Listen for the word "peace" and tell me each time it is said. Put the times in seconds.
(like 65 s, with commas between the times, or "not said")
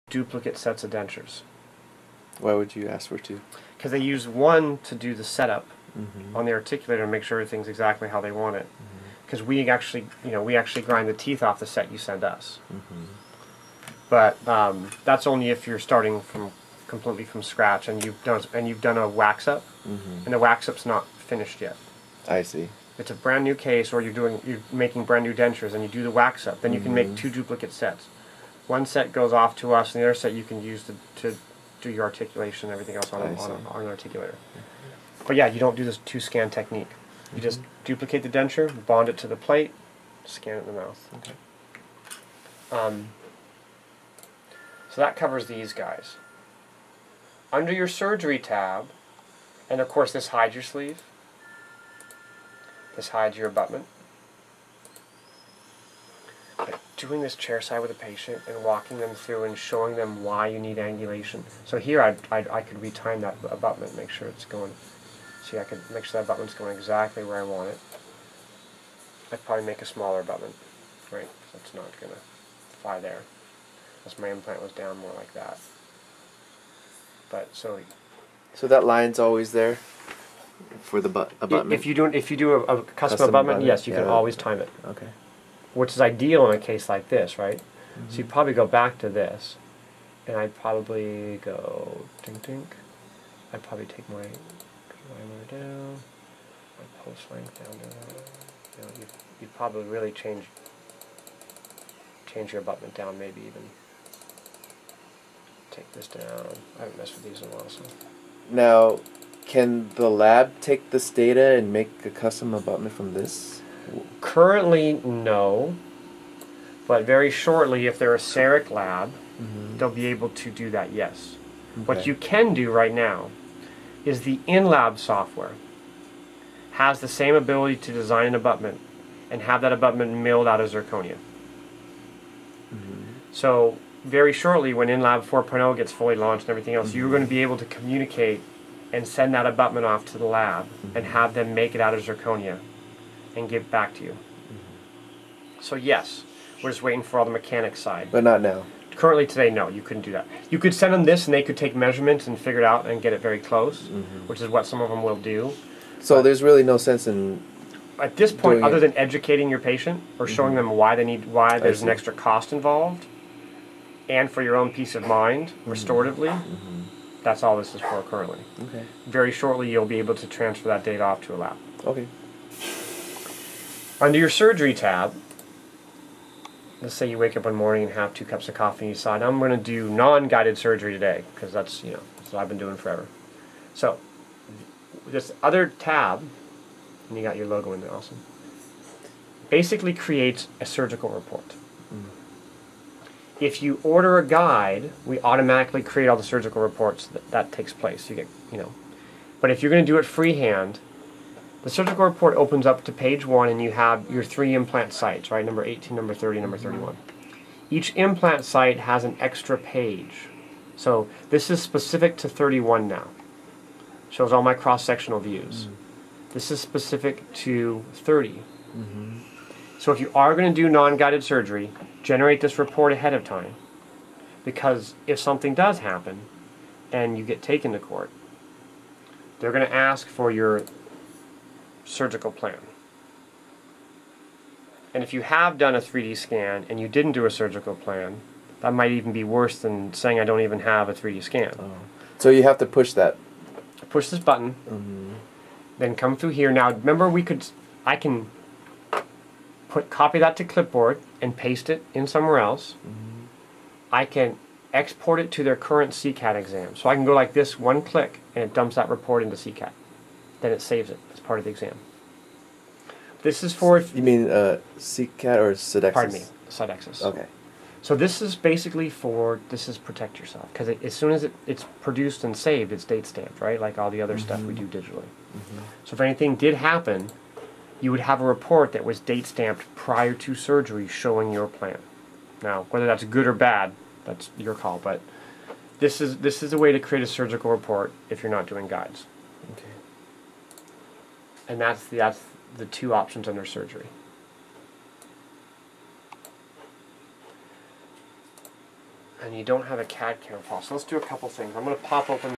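164 s.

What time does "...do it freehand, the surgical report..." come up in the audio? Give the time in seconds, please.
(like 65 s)
199 s.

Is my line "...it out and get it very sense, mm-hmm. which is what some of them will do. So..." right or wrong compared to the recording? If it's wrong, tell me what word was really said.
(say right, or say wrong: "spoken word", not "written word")
wrong: "close", not "sense".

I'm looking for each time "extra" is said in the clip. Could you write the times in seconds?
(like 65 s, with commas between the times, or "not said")
161 s, 209 s.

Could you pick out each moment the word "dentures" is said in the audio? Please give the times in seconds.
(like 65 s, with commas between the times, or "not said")
0 s, 25 s, 38 s.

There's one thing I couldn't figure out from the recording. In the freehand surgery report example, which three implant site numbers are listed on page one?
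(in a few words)
18, 30 and 31.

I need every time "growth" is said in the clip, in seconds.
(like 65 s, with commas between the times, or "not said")
not said.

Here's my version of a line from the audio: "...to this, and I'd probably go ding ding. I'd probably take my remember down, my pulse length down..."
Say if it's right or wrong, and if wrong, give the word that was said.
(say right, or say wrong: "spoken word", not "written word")
wrong: "liner", not "remember".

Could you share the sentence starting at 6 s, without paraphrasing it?
on the articulator and make sure everything's exactly how they want it.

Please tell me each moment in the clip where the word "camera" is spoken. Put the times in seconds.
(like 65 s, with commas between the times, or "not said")
300 s.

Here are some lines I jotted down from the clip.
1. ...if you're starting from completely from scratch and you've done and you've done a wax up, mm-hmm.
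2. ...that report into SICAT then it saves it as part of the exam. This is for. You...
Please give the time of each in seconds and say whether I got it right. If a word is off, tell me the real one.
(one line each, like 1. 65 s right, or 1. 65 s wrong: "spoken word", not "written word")
1. 15 s right
2. 258 s right.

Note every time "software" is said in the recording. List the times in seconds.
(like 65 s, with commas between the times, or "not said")
124 s.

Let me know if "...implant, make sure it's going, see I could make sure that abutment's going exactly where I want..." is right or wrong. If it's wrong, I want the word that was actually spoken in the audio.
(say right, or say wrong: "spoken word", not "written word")
wrong: "abutment", not "implant".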